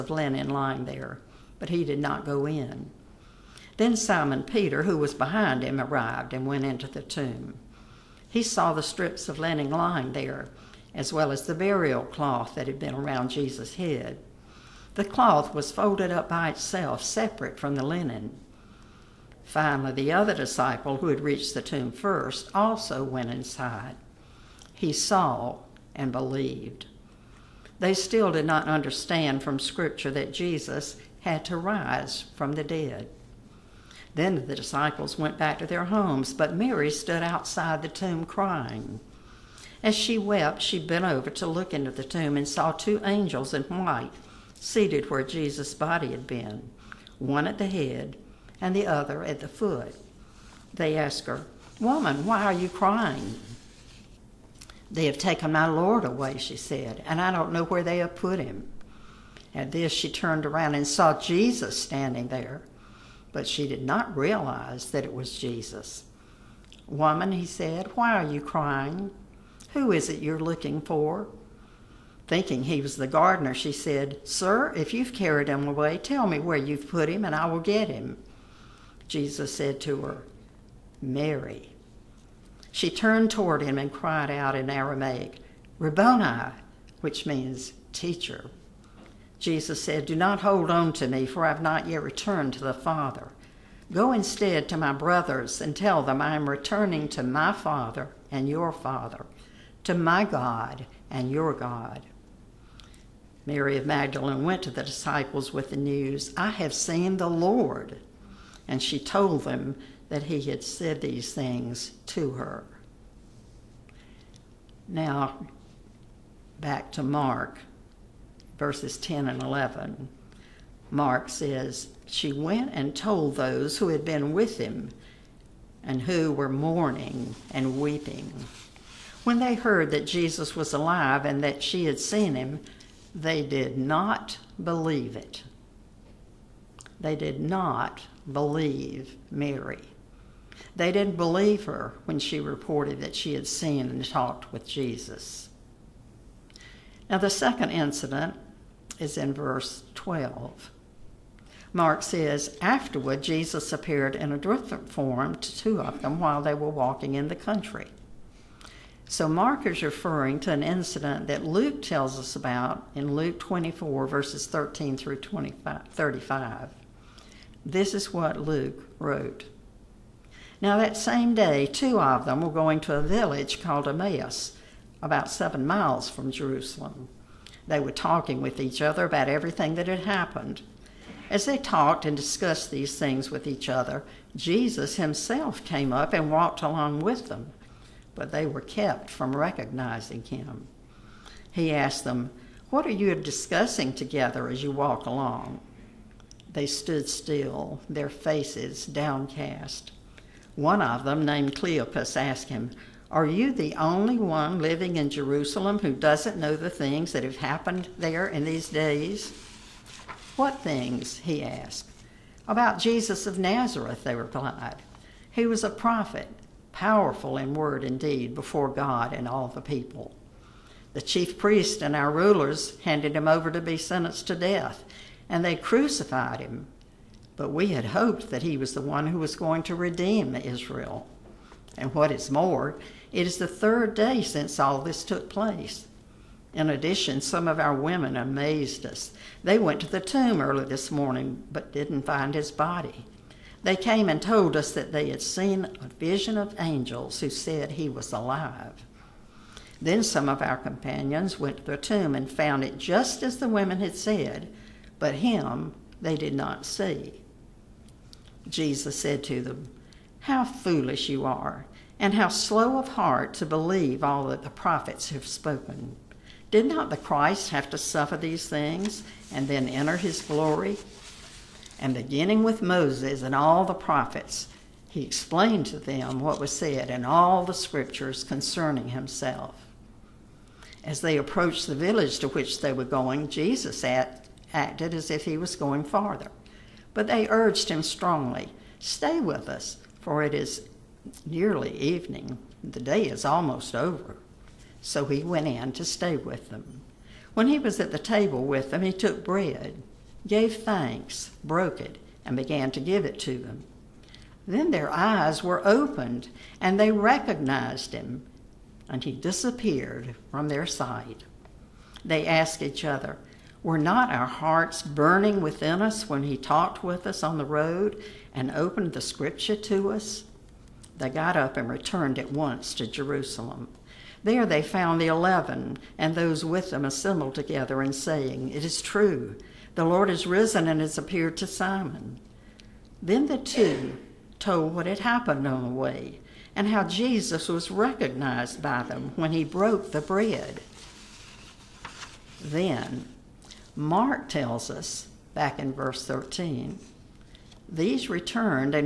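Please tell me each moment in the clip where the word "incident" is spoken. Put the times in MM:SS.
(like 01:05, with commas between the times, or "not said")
02:27, 02:40.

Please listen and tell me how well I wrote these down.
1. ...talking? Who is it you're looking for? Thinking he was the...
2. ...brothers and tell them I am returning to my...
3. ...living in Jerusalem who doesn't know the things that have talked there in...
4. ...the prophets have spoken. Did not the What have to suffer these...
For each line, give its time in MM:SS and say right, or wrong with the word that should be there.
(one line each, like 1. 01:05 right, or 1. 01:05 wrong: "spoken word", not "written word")
1. 01:08 wrong: "crying", not "talking"
2. 01:34 right
3. 03:24 wrong: "happened", not "talked"
4. 04:24 wrong: "Christ", not "What".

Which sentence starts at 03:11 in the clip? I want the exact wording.
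He asked them, What are you discussing together as you walk along?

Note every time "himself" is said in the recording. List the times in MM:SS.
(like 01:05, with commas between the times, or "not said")
03:04, 04:38.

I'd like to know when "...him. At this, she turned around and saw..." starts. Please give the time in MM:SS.
00:58.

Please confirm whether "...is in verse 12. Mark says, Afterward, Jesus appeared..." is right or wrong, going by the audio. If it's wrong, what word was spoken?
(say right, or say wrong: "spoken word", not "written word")
right.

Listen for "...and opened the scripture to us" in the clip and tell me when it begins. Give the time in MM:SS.
05:18.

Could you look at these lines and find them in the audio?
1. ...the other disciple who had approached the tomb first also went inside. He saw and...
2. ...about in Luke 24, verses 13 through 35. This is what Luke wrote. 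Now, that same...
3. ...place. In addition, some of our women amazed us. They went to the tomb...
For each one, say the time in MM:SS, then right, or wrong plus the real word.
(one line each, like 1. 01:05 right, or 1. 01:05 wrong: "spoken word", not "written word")
1. 00:19 wrong: "reached", not "approached"
2. 02:42 right
3. 03:55 right.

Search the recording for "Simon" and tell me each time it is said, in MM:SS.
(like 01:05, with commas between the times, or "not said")
00:03, 05:31.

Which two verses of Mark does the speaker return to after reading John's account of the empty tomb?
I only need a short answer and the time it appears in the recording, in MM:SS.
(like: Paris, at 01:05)
10 and 11, at 01:58.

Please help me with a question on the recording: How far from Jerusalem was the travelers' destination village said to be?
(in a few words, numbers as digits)
7 miles.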